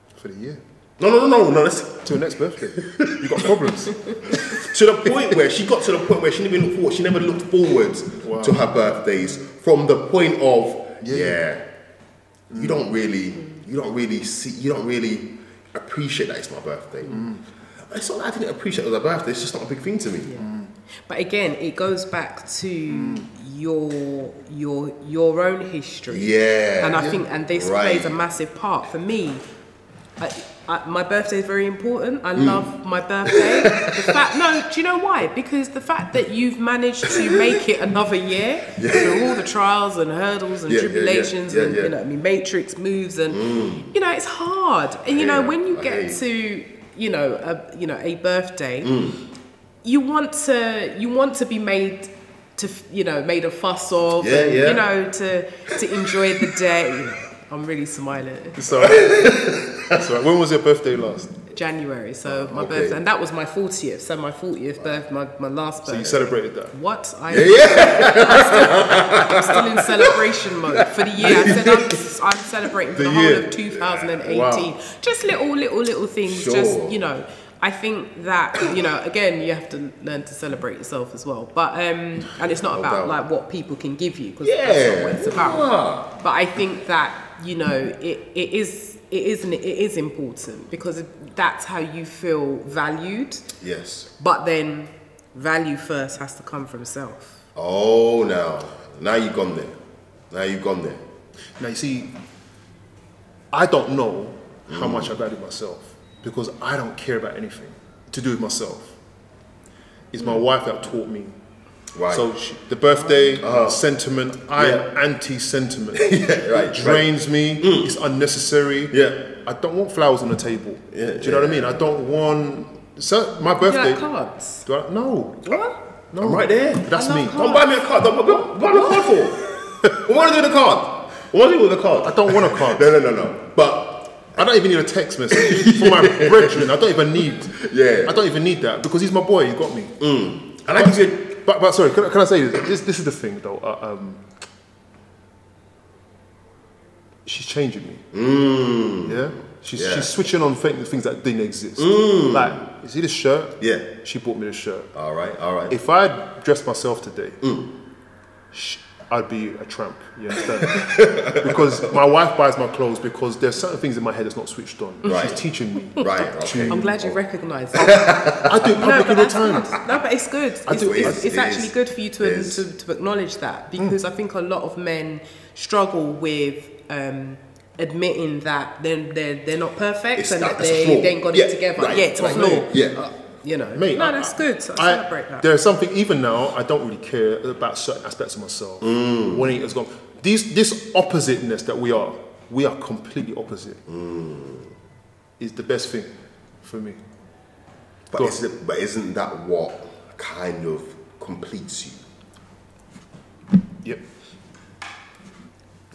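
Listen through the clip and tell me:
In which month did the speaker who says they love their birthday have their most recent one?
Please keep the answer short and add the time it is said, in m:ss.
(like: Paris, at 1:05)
January, at 1:01.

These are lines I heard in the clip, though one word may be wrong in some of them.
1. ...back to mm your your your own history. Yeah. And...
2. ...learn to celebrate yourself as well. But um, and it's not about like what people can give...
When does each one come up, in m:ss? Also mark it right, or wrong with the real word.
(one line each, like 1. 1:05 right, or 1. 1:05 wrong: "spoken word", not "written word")
1. 0:22 right
2. 1:20 right.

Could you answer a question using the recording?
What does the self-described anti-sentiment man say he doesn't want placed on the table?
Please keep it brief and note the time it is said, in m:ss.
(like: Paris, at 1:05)
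Flowers, at 1:59.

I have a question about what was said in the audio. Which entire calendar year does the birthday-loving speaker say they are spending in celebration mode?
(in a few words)
2018.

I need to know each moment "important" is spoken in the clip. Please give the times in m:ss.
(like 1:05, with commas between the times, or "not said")
0:31, 1:29.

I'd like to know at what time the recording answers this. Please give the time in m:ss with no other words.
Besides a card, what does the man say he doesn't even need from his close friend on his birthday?
2:14.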